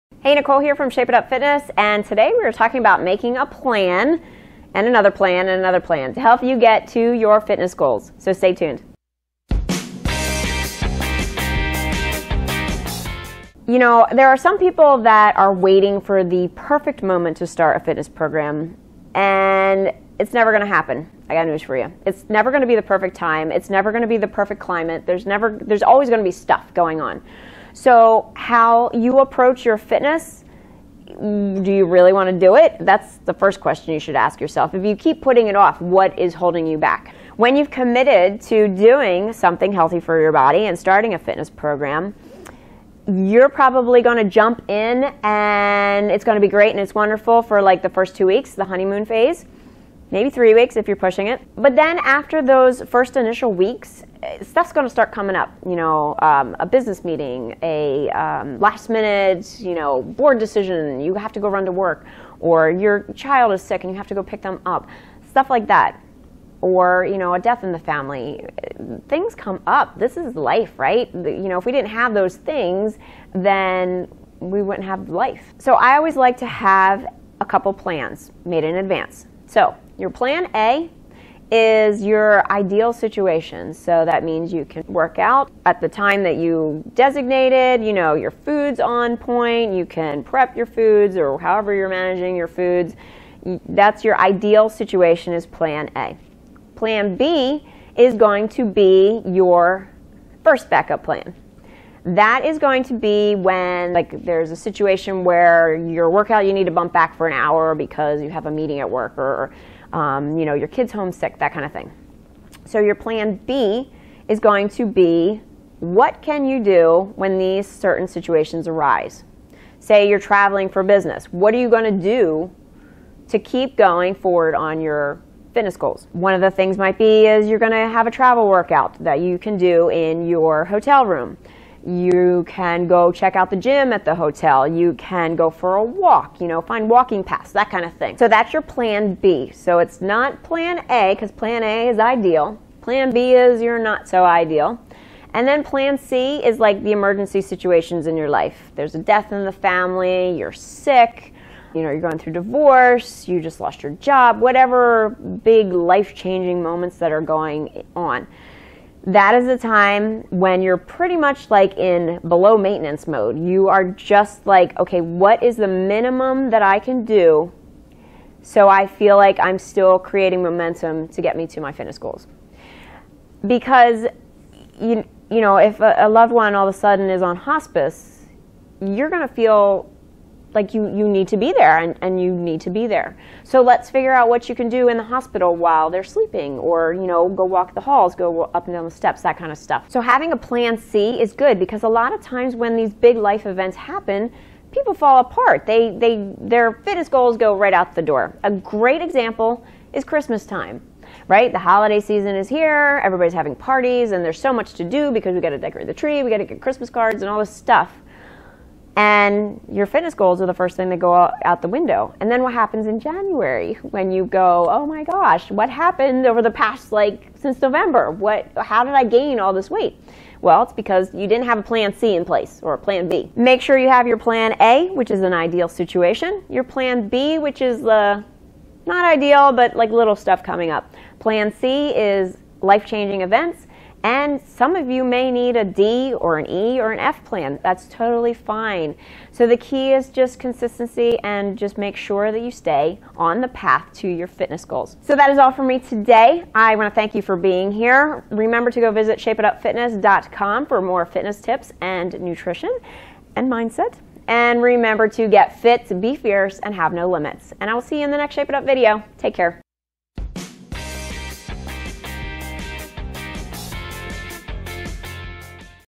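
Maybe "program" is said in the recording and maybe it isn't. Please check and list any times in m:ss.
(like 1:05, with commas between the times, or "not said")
0:18, 0:41.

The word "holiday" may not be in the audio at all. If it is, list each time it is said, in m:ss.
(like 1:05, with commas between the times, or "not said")
3:21.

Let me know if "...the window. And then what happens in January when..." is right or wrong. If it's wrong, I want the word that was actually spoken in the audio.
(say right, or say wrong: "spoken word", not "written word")
right.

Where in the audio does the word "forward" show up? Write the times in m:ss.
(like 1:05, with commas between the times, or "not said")
2:04.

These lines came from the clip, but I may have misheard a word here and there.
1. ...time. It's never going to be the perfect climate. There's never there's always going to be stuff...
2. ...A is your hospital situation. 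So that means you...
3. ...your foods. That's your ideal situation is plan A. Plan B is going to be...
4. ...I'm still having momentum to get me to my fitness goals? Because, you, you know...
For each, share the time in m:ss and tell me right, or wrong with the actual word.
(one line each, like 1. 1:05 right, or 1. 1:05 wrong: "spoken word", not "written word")
1. 0:23 right
2. 1:20 wrong: "ideal", not "hospital"
3. 1:32 right
4. 2:49 wrong: "creating", not "having".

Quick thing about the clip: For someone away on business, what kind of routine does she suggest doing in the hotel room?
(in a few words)
Travel workout.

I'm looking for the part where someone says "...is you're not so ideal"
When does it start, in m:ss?
2:23.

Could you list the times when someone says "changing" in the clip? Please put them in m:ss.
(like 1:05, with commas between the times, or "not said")
2:36, 3:52.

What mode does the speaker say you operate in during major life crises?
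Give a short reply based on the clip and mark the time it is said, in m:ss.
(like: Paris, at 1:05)
Maintenance mode, at 2:42.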